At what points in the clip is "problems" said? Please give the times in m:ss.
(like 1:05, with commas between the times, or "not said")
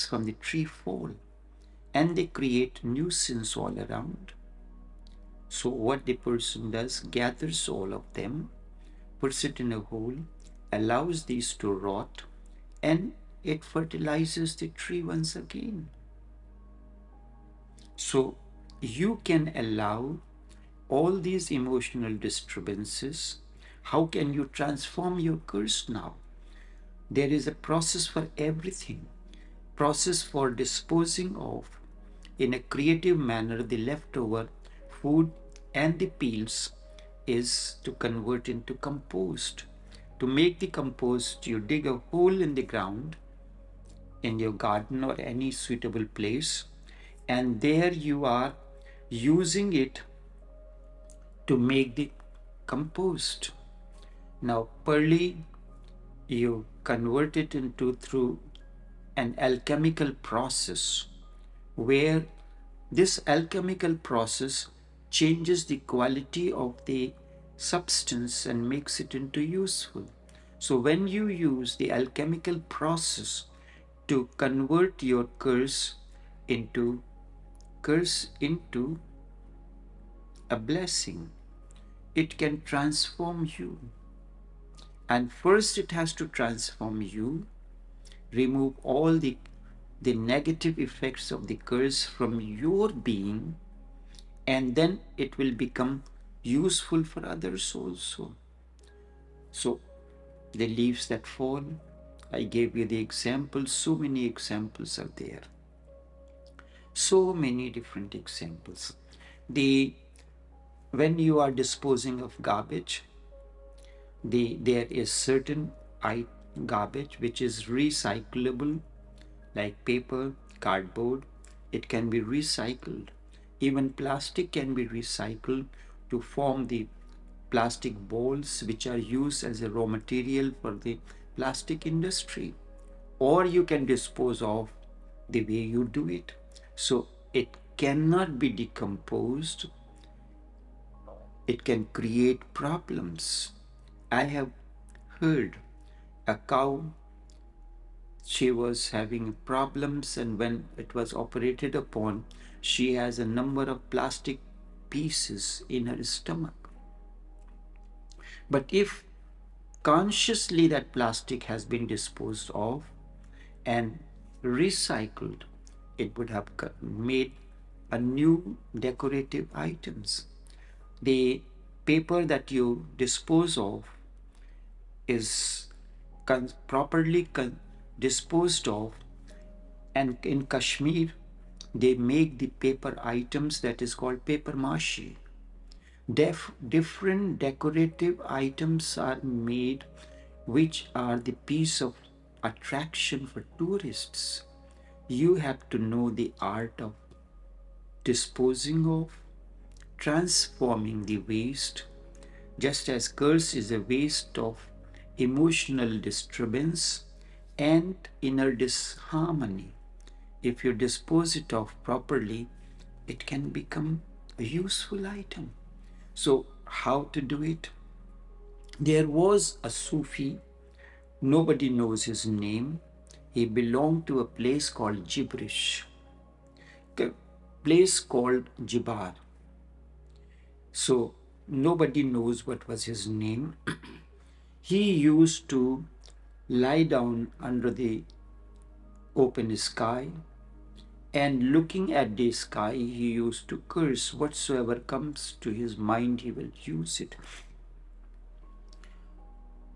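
2:22, 2:29.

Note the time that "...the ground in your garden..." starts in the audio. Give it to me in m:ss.
0:42.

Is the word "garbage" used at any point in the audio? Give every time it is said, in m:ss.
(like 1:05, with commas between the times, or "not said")
1:52, 1:56.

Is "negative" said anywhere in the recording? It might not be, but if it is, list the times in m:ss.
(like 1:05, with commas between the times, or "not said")
1:30.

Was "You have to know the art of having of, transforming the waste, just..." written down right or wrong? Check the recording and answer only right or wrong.
wrong.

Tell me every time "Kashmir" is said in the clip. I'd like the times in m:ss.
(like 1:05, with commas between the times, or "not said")
3:00.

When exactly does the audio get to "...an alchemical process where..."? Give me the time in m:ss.
0:59.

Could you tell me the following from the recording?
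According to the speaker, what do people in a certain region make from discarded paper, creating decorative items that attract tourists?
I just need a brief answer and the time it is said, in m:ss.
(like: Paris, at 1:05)
Paper mache, at 3:04.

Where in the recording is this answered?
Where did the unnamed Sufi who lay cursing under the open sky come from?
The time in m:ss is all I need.
3:48.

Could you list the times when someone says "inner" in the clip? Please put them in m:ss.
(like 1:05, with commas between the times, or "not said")
3:28.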